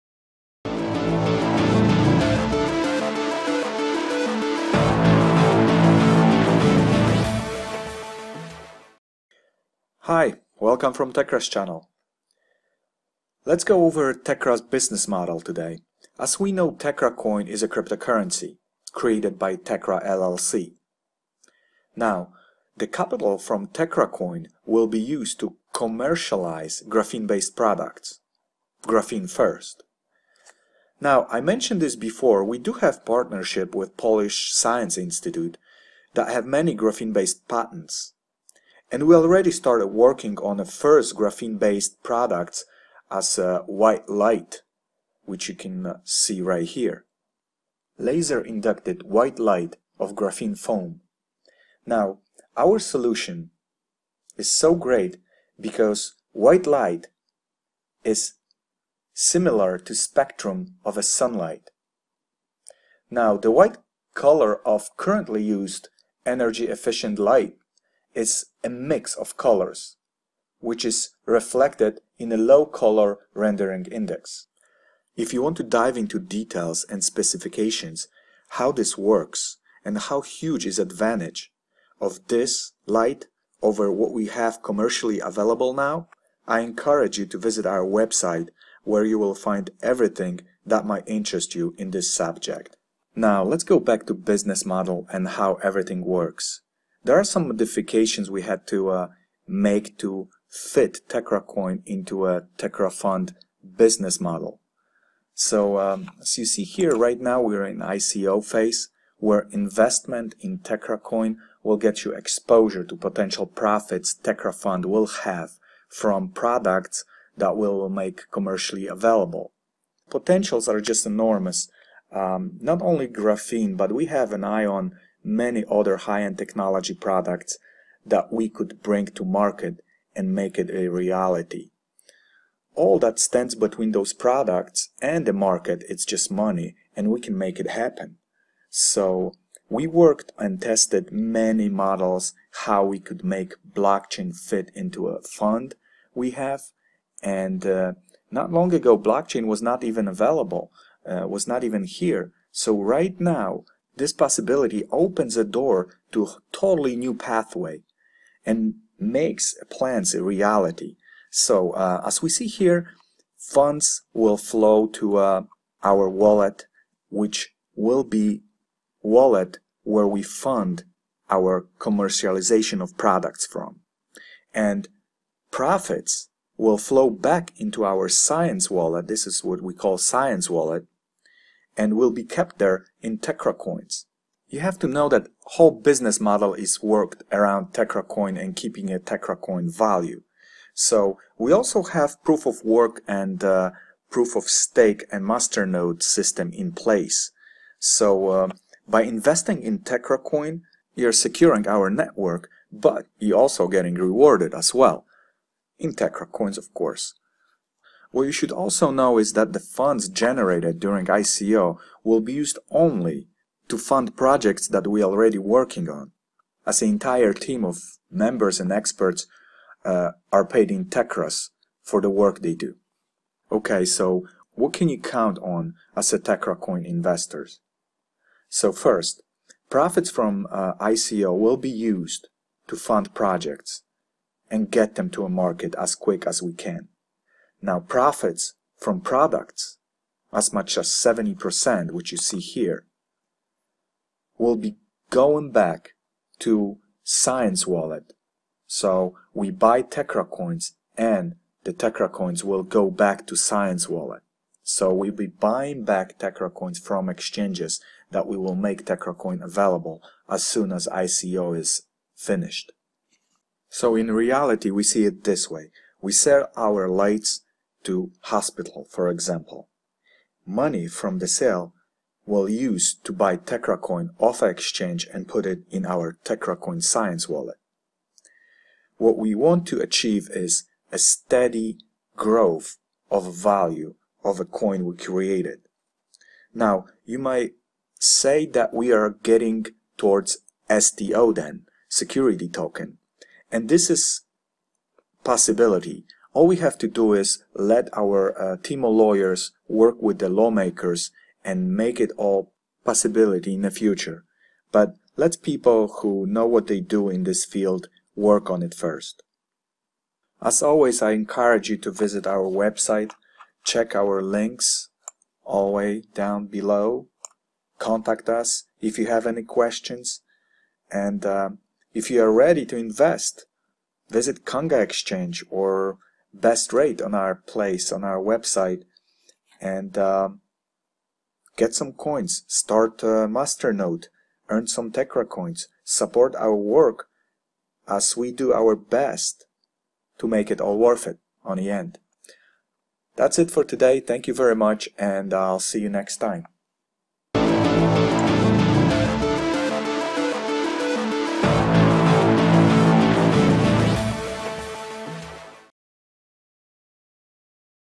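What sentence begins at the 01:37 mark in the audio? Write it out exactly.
There are some modifications we had to uh, make to fit Coin into a Fund business model.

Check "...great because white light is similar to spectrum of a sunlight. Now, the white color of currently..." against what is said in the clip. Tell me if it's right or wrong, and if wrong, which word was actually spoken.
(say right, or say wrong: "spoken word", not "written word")
right.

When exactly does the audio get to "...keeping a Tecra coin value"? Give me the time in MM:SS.
03:08.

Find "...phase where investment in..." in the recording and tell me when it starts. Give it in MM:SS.
01:48.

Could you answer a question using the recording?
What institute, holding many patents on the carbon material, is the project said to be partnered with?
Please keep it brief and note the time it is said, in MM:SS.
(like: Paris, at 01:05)
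Polish Science Institute, at 00:33.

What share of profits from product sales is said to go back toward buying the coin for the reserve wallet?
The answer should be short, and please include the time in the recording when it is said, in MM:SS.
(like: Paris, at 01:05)
70%, at 04:00.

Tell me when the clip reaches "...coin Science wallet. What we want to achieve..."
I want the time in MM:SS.
04:36.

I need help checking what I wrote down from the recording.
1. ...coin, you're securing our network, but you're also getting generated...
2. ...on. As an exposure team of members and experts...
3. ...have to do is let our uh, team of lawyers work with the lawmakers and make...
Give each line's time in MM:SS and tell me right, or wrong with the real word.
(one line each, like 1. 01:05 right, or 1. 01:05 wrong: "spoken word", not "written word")
1. 03:20 wrong: "rewarded", not "generated"
2. 03:35 wrong: "entire", not "exposure"
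3. 04:56 right.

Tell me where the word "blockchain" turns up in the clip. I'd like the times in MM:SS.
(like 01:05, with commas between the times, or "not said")
02:23, 02:28.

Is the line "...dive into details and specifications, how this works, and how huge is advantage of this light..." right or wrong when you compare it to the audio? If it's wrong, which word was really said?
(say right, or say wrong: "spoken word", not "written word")
right.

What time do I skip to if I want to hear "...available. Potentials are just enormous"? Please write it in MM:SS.
01:58.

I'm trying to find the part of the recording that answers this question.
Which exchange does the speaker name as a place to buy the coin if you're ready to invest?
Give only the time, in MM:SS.
05:24.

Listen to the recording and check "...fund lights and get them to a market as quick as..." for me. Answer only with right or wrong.
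wrong.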